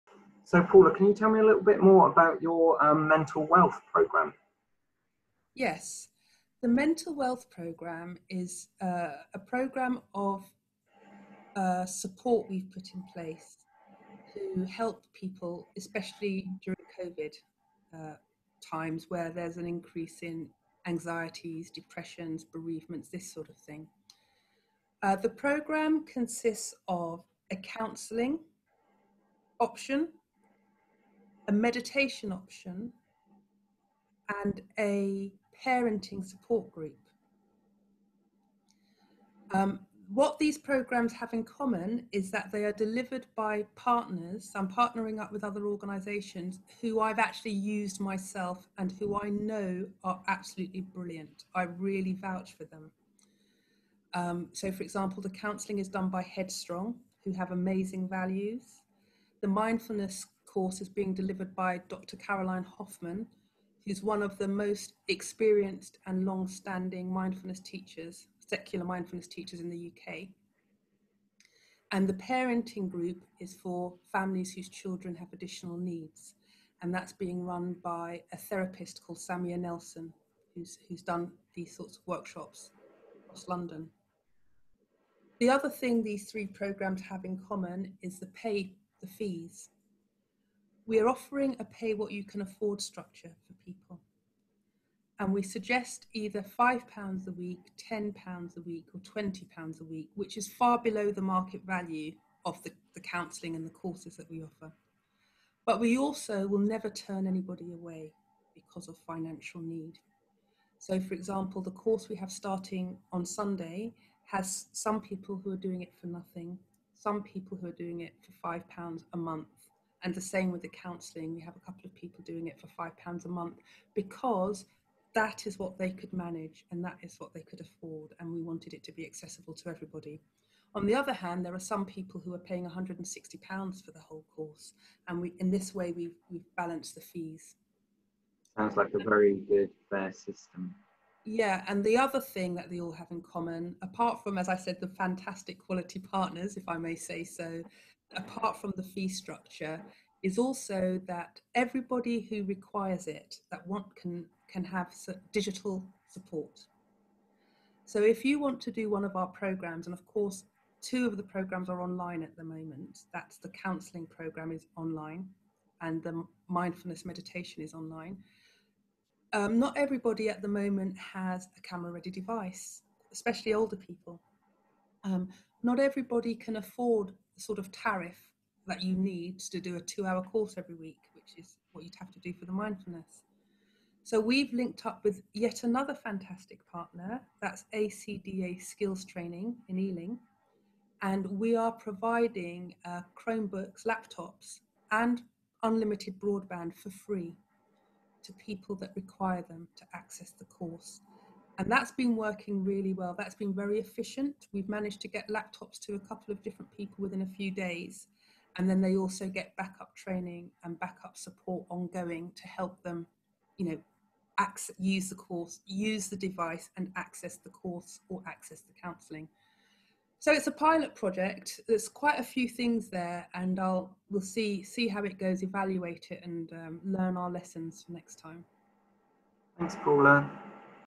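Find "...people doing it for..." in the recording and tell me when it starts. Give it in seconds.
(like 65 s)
121 s.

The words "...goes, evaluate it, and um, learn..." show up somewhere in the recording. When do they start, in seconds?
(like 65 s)
225 s.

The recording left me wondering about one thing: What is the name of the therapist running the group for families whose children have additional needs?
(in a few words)
Samia Nelson.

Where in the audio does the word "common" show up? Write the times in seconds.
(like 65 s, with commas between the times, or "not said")
41 s, 87 s, 143 s.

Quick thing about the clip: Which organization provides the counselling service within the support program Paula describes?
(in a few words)
Headstrong.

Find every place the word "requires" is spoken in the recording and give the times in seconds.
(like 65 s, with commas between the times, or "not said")
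152 s, 198 s.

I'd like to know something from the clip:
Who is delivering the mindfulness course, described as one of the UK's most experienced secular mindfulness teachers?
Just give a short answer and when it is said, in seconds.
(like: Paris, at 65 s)
Dr. Caroline Hoffman, at 61 s.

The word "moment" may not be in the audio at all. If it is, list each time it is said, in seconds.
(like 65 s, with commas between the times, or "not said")
162 s, 170 s.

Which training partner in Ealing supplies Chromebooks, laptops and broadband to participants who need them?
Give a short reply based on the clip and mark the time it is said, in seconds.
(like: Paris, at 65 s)
ACDA Skills Training, at 187 s.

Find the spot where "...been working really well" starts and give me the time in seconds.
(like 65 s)
201 s.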